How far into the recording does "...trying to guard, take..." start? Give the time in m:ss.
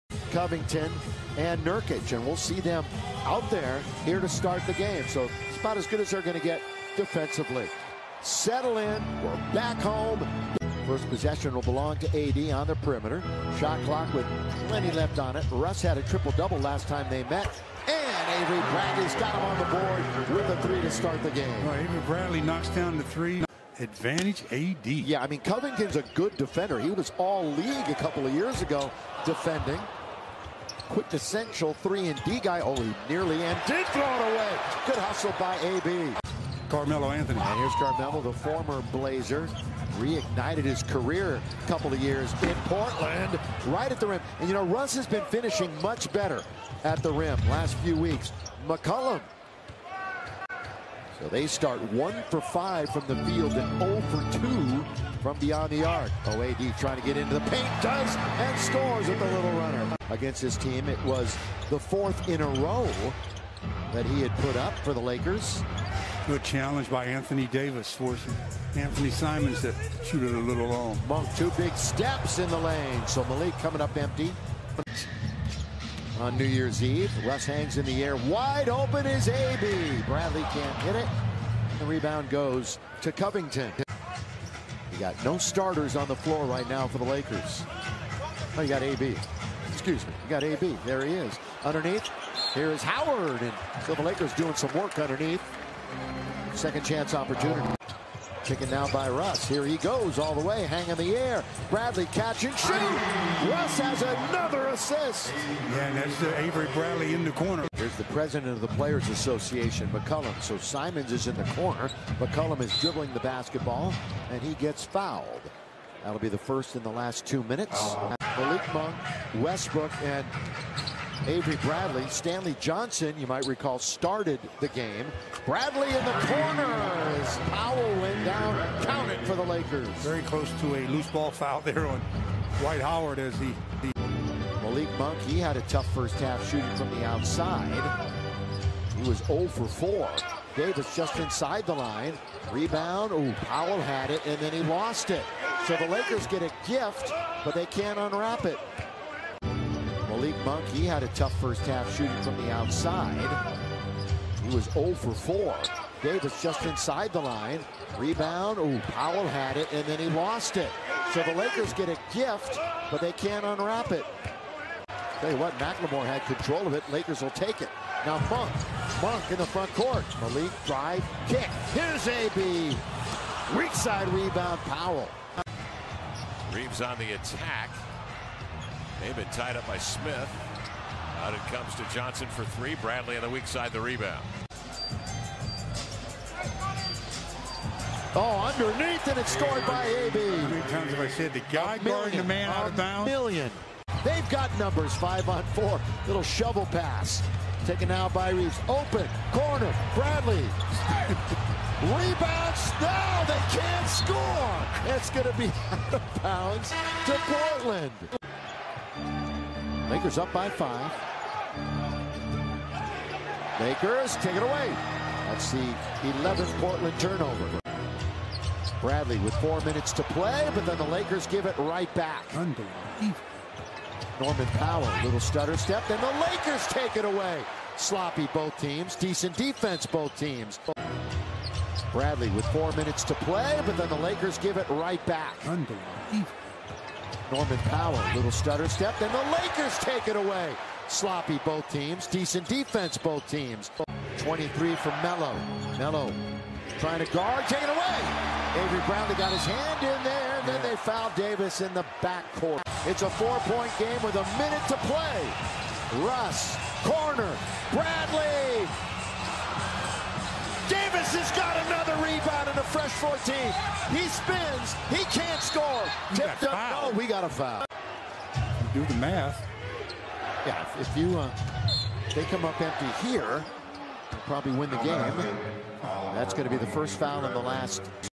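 4:06.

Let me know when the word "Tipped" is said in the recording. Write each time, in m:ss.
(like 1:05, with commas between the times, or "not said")
4:26.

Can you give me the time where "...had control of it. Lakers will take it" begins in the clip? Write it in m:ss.
2:46.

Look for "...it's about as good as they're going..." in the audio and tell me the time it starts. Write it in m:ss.
0:05.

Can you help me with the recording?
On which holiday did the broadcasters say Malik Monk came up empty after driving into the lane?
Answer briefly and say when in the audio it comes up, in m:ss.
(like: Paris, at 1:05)
New Year's Eve, at 1:16.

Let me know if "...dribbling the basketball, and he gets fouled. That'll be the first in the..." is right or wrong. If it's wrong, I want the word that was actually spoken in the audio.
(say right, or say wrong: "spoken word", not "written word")
right.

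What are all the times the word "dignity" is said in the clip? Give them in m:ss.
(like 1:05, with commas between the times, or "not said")
not said.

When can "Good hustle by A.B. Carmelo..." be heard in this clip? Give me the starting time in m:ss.
0:34.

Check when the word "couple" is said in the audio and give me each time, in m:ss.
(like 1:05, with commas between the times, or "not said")
0:27, 0:41.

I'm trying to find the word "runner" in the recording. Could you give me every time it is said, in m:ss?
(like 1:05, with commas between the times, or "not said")
0:59.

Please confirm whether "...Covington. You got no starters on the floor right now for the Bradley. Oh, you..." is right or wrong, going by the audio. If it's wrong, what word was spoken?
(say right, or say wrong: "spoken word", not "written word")
wrong: "Lakers", not "Bradley".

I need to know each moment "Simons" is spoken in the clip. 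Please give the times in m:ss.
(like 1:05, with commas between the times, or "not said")
1:09, 1:50.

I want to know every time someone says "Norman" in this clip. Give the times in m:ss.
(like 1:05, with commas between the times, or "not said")
3:42, 3:57.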